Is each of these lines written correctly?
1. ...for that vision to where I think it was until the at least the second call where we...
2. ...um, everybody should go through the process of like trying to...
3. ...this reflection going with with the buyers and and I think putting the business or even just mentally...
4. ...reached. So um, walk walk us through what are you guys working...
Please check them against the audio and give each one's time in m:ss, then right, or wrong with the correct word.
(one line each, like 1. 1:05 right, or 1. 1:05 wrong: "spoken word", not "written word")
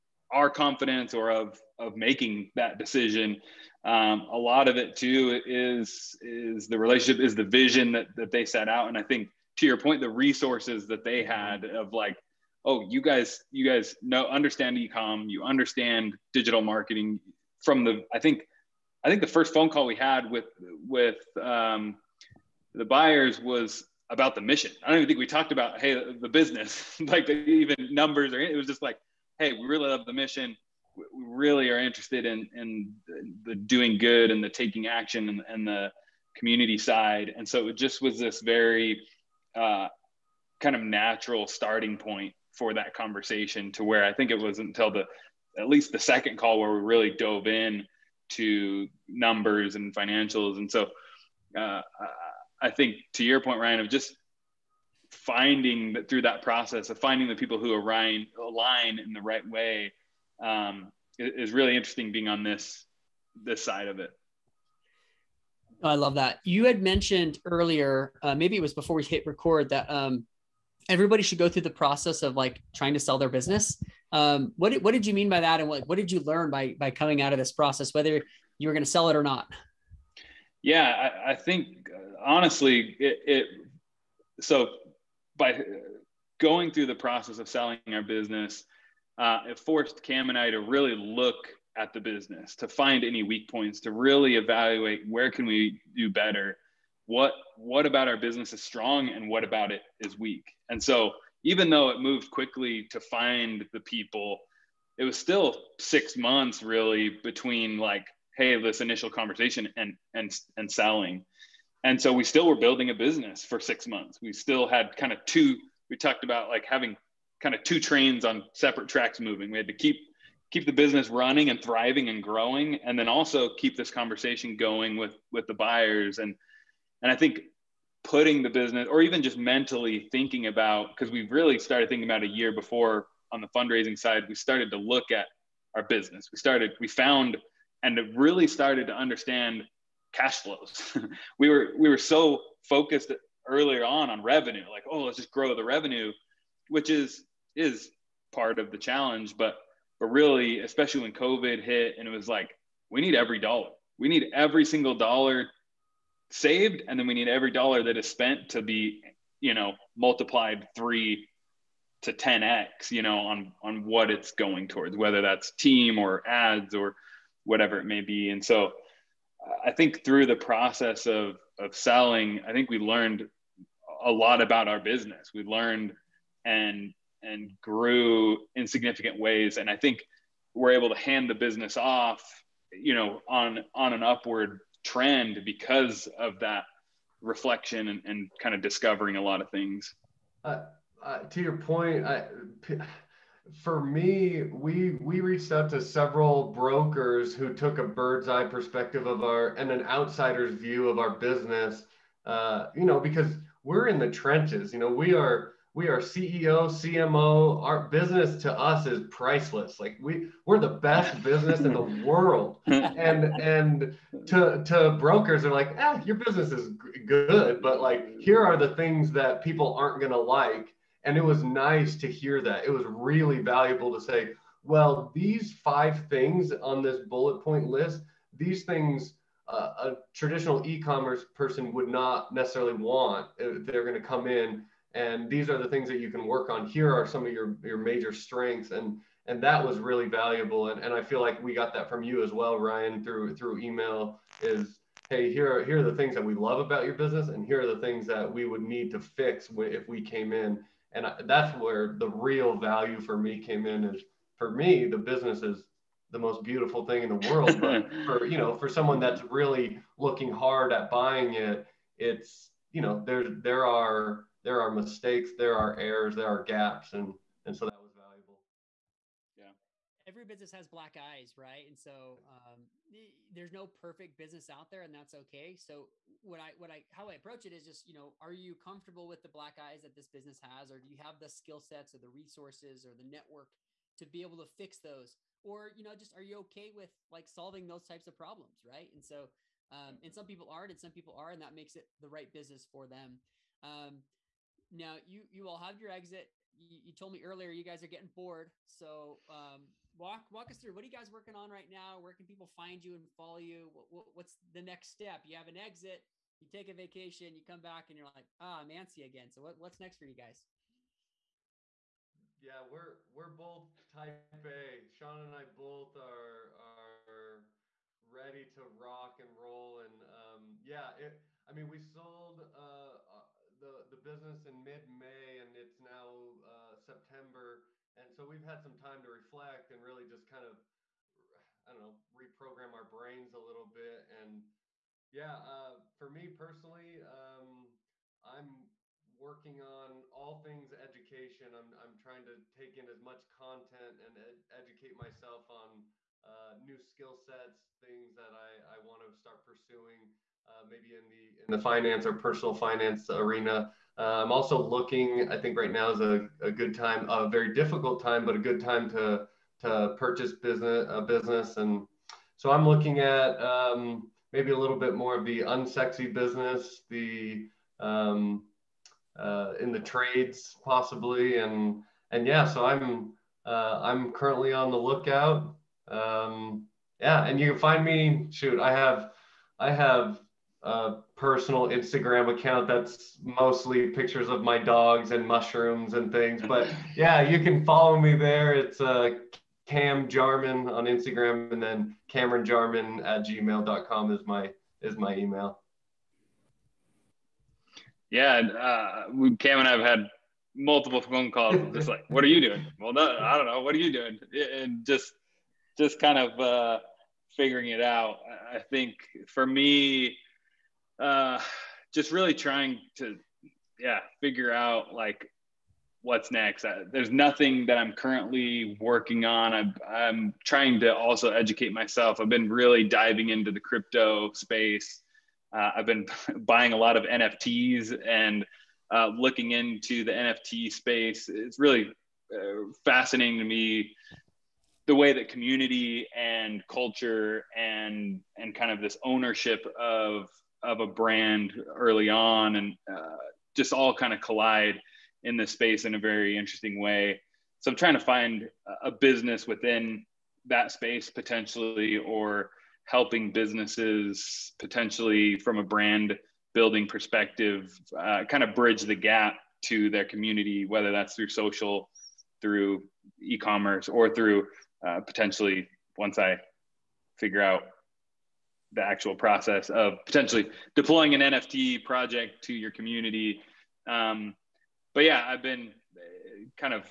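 1. 0:42 wrong: "conversation", not "vision"
2. 1:09 right
3. 2:03 wrong: "conversation", not "reflection"
4. 4:58 wrong: "bored", not "reached".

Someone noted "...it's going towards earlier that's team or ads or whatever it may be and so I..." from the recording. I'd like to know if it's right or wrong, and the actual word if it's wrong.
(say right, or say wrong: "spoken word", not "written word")
wrong: "whether", not "earlier".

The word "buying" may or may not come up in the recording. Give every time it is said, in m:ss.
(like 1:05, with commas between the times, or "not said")
4:20, 7:06.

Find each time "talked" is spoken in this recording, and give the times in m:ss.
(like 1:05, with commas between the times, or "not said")
0:25, 1:55.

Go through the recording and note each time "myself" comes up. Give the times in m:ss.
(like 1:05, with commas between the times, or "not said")
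5:44, 7:01.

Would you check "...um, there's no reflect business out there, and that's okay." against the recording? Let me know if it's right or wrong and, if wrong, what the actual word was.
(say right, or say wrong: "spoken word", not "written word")
wrong: "perfect", not "reflect".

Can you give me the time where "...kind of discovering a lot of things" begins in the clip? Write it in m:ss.
3:08.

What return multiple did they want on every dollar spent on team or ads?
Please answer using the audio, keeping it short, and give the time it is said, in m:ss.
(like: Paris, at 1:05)
3 to 10x, at 2:40.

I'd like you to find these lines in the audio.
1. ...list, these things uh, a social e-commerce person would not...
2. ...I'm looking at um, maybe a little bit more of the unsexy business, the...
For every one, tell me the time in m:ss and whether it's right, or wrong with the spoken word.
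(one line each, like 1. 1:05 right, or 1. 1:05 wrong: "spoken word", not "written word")
1. 3:47 wrong: "traditional", not "social"
2. 6:02 right.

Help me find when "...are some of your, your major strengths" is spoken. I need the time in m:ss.
3:56.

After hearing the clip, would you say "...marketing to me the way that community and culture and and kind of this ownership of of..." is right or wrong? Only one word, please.
wrong.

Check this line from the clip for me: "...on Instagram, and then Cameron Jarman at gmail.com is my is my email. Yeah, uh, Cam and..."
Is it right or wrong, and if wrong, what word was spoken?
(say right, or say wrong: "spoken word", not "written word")
right.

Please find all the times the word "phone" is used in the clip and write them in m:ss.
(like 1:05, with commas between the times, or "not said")
0:19, 6:41.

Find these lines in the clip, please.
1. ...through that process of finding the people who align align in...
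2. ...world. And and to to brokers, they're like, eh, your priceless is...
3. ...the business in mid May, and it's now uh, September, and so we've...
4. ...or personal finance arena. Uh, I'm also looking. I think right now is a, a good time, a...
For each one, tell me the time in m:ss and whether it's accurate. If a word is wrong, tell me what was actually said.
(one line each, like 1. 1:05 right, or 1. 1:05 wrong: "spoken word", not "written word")
1. 0:56 right
2. 3:32 wrong: "business", not "priceless"
3. 5:23 right
4. 5:52 right.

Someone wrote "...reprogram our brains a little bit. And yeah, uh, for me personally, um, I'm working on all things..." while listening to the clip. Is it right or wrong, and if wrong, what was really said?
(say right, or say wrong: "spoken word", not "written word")
right.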